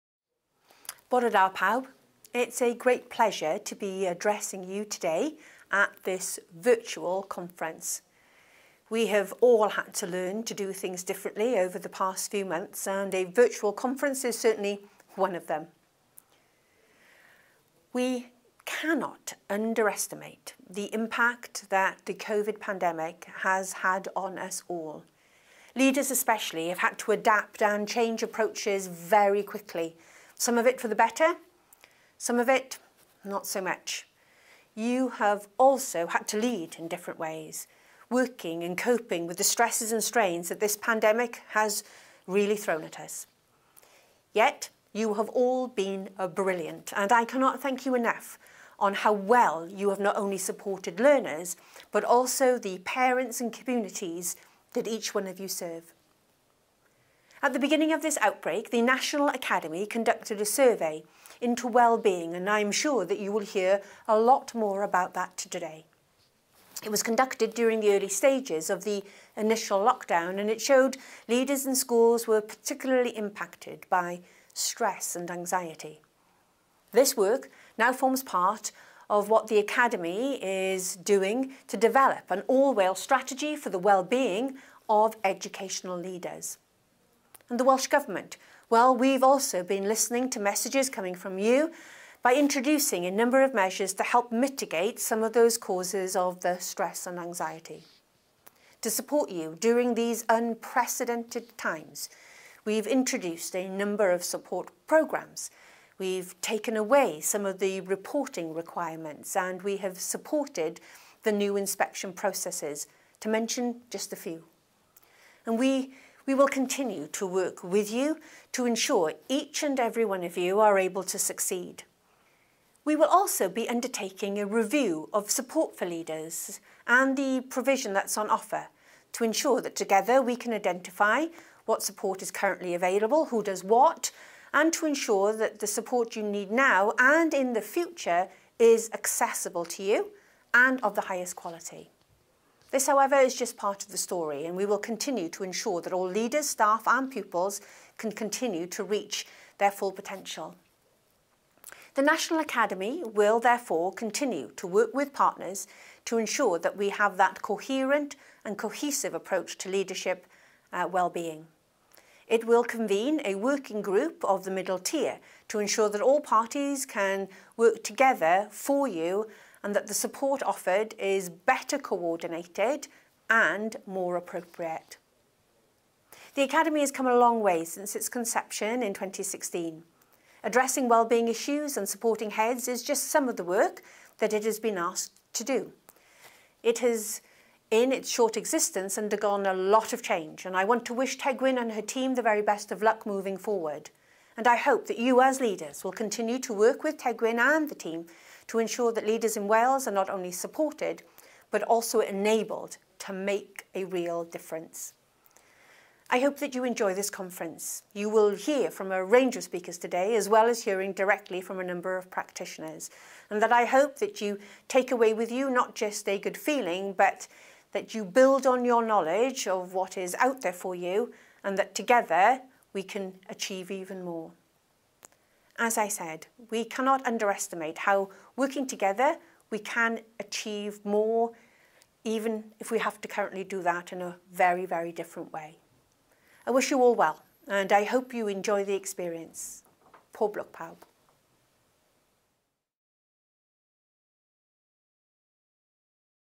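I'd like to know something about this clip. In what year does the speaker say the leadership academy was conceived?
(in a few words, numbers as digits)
2016.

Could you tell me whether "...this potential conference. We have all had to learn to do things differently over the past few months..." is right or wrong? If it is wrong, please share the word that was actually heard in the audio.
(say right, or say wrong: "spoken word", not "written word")
wrong: "virtual", not "potential".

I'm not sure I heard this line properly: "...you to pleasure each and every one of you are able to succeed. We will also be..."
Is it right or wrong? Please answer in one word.
wrong.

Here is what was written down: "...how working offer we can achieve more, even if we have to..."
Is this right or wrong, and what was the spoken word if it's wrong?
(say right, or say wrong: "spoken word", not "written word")
wrong: "together", not "offer".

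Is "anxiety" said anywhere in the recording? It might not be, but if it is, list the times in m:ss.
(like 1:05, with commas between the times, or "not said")
1:15, 1:37.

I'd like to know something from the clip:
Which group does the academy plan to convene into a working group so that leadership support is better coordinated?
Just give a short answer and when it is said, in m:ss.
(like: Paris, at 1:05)
the middle tier, at 2:44.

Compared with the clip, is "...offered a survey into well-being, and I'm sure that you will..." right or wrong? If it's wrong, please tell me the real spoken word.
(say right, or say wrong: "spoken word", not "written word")
wrong: "conducted", not "offered".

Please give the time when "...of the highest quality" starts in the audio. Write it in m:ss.
2:20.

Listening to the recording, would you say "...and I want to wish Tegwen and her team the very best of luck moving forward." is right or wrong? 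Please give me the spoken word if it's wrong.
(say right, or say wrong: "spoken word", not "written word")
right.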